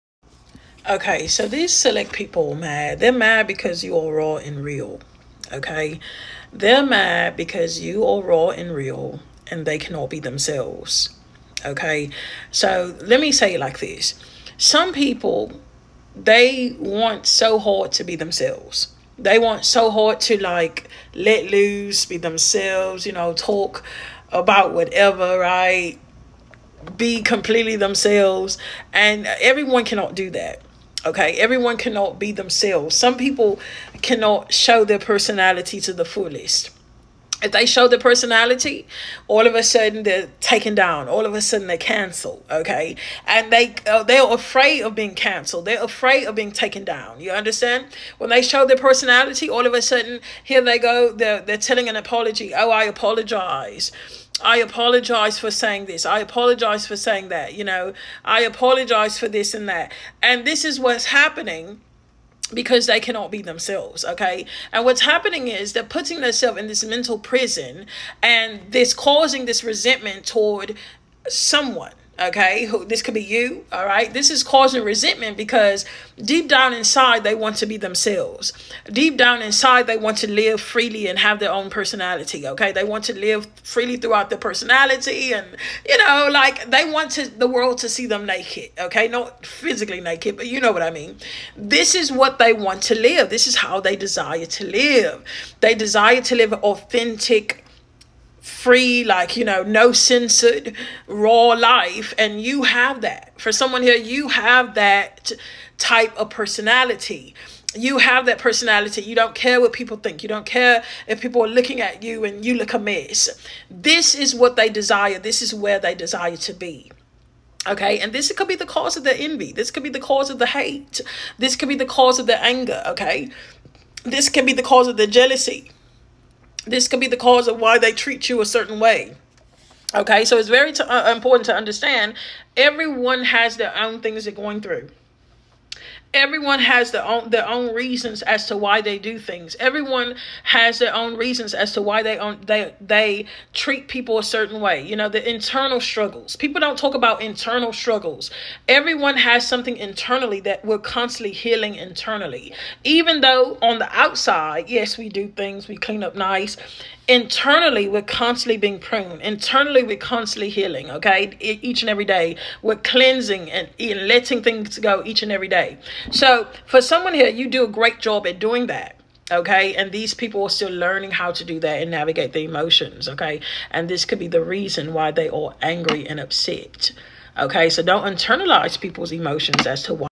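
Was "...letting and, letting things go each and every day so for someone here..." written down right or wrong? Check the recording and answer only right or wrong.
wrong.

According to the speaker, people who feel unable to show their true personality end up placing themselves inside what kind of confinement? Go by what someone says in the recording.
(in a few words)
mental prison.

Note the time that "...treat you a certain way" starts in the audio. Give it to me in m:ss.
2:07.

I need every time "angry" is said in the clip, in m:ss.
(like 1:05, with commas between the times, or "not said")
2:55.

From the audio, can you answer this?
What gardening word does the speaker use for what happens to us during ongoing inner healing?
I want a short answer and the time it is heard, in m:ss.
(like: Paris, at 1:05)
pruned, at 2:38.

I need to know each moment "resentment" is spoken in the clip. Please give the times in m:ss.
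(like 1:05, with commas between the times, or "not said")
1:09, 1:14.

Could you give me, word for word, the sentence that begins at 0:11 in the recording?
Okay, so let me say it like this: some people they want so hard to be themselves.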